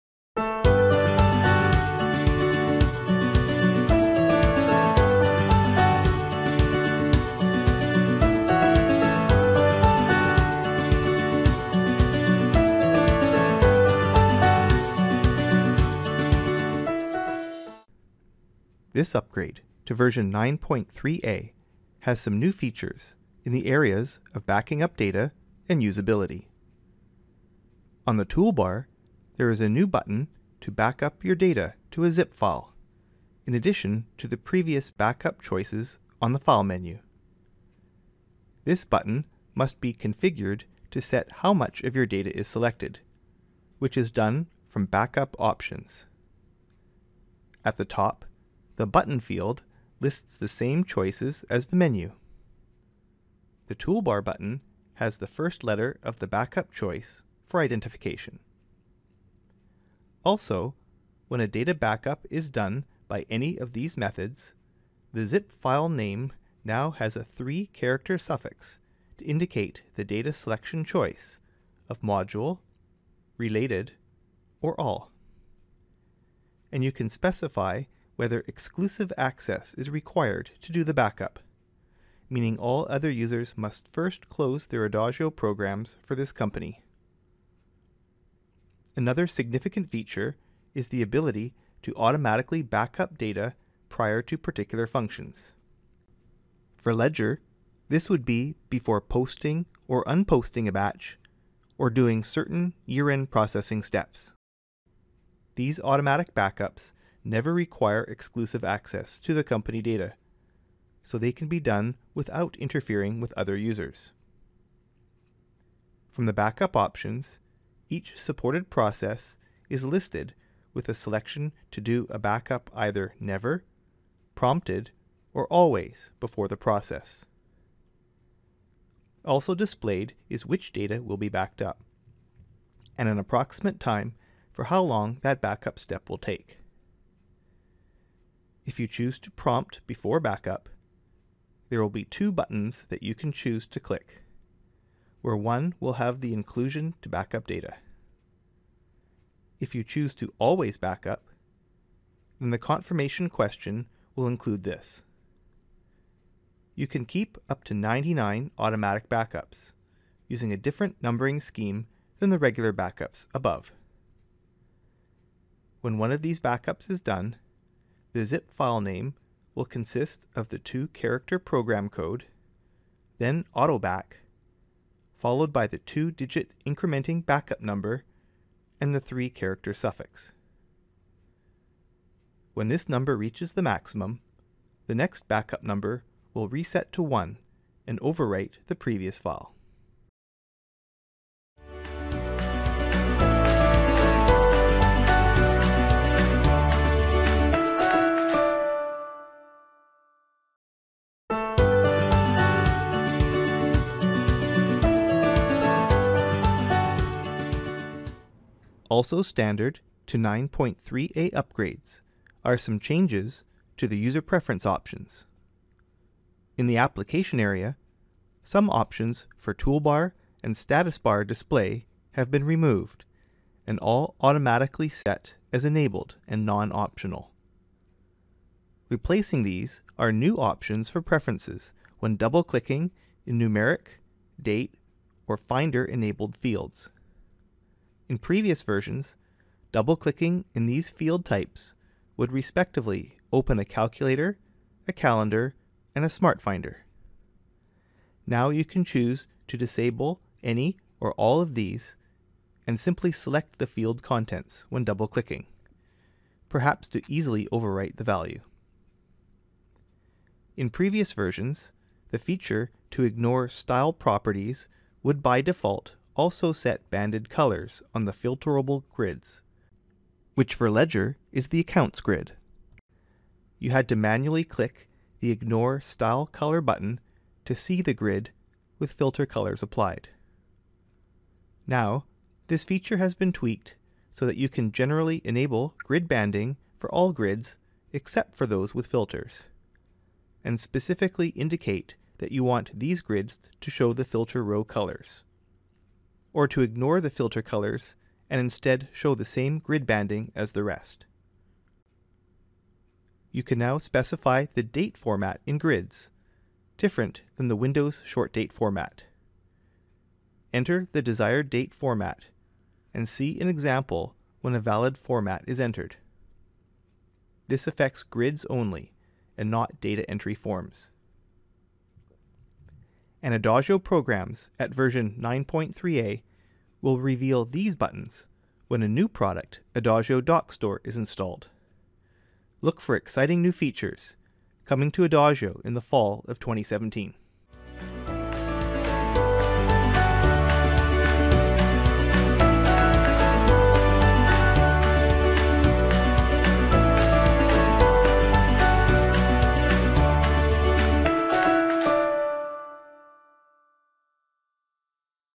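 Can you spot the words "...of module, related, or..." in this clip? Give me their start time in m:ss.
1:11.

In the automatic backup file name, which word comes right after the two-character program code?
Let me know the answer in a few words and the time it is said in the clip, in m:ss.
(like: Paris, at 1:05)
autoback, at 2:53.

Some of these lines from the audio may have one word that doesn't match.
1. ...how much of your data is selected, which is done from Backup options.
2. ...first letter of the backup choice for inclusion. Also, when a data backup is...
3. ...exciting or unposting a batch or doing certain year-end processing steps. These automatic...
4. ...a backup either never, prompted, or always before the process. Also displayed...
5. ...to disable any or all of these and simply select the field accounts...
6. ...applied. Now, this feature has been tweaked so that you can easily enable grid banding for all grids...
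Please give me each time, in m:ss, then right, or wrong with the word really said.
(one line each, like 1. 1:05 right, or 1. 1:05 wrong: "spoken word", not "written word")
1. 0:41 right
2. 0:55 wrong: "identification", not "inclusion"
3. 1:39 wrong: "posting", not "exciting"
4. 2:02 right
5. 4:09 wrong: "contents", not "accounts"
6. 4:39 wrong: "generally", not "easily".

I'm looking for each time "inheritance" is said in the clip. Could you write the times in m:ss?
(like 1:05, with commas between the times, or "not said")
not said.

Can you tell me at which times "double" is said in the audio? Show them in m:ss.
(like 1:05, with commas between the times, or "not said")
3:52, 3:59, 4:14.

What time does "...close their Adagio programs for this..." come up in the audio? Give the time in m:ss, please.
1:24.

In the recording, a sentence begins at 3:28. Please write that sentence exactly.
Also standard to 9.3a upgrades are some changes to the user preference options.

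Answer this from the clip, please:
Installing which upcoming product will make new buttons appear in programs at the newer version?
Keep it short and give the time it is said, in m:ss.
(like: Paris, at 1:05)
Adagio DocStore, at 5:29.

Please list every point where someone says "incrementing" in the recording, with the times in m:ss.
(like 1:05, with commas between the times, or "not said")
2:56.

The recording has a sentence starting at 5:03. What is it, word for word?
You can now specify the date format in grids, different than the Windows short date format.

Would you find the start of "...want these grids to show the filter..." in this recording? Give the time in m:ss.
4:52.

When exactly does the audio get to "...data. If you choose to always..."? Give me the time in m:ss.
2:27.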